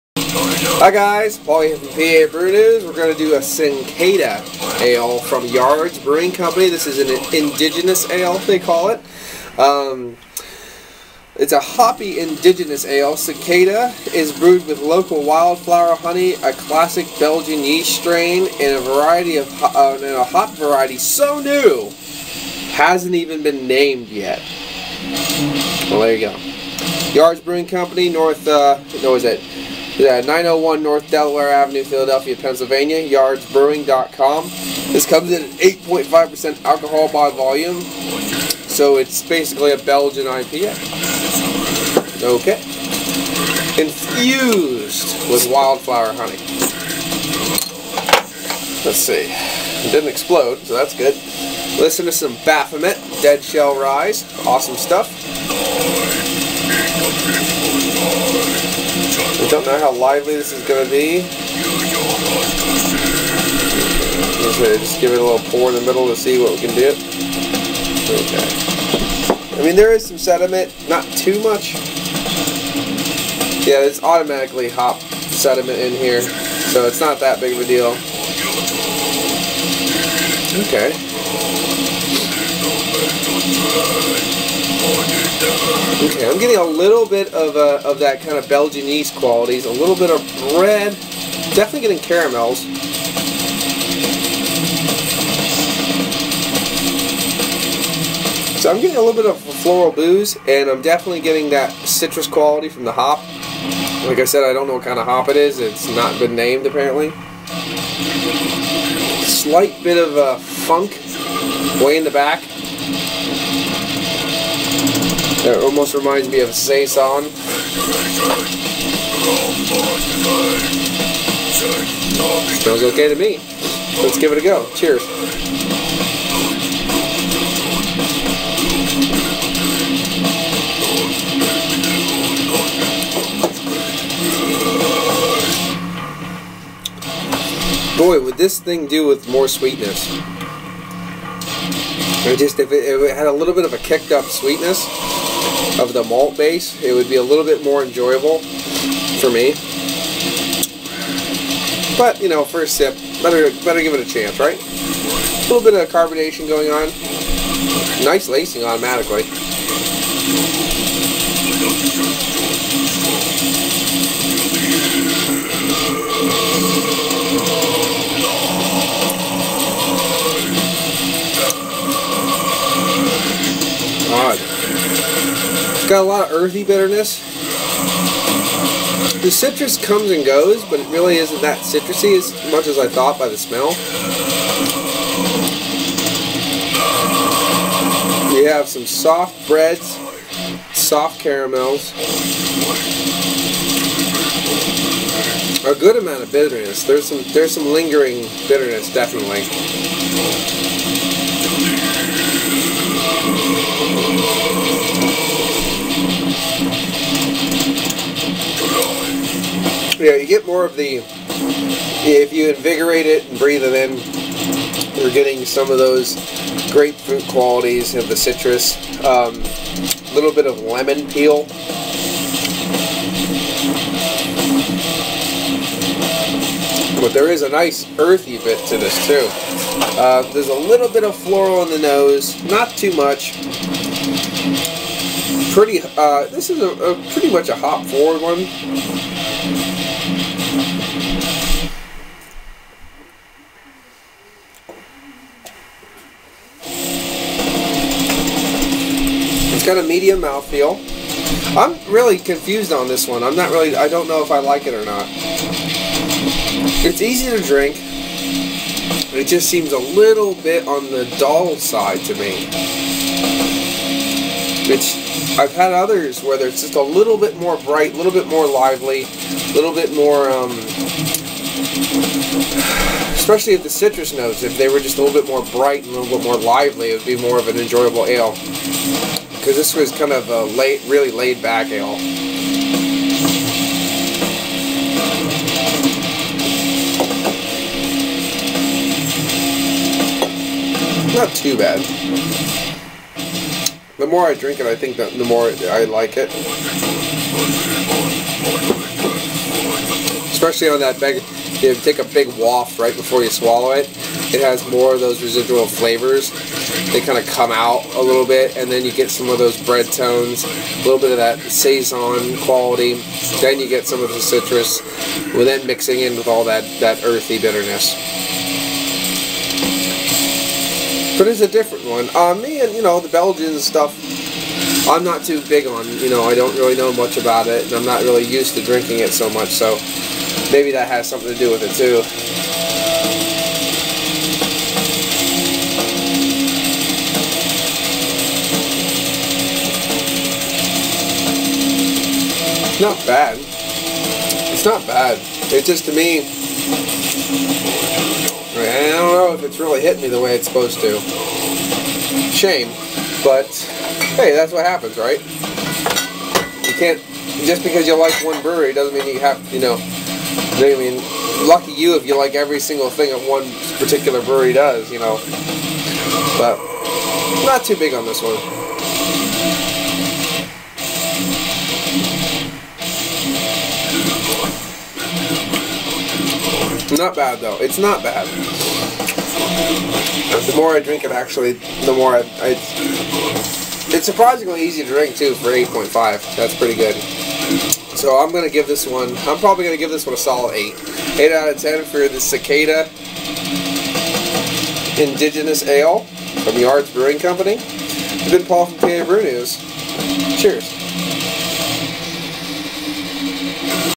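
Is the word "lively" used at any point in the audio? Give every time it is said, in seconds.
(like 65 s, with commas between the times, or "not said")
59 s, 268 s, 276 s.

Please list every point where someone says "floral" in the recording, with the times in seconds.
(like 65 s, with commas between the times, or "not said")
99 s, 231 s.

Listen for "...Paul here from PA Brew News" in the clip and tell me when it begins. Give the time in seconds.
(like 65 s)
1 s.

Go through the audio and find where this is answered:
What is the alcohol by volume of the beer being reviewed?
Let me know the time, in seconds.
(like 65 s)
35 s.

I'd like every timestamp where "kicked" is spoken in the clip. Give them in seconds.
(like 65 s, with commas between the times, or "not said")
143 s.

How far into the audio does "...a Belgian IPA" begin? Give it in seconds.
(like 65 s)
39 s.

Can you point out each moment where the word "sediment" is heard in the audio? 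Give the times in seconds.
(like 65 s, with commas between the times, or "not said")
70 s, 75 s.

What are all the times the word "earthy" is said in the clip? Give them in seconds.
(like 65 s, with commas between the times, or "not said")
176 s, 227 s, 317 s.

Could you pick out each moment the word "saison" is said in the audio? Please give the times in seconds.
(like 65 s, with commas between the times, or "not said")
116 s, 311 s.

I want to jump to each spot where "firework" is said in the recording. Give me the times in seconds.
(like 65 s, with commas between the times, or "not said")
not said.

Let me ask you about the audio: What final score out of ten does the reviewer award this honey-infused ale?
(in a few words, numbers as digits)
8.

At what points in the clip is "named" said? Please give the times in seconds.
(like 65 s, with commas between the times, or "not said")
23 s, 106 s.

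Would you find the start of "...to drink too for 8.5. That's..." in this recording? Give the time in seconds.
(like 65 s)
384 s.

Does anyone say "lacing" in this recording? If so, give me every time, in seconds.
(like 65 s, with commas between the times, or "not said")
158 s.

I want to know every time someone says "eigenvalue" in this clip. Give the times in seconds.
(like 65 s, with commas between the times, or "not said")
not said.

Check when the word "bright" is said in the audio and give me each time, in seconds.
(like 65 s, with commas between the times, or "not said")
267 s, 275 s.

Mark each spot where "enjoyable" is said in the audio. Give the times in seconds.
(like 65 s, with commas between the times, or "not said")
147 s, 277 s.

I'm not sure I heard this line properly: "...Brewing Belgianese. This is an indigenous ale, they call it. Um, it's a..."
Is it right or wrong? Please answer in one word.
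wrong.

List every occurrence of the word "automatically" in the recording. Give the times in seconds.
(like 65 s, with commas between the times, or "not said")
74 s, 158 s.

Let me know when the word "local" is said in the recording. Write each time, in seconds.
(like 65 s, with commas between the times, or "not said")
14 s.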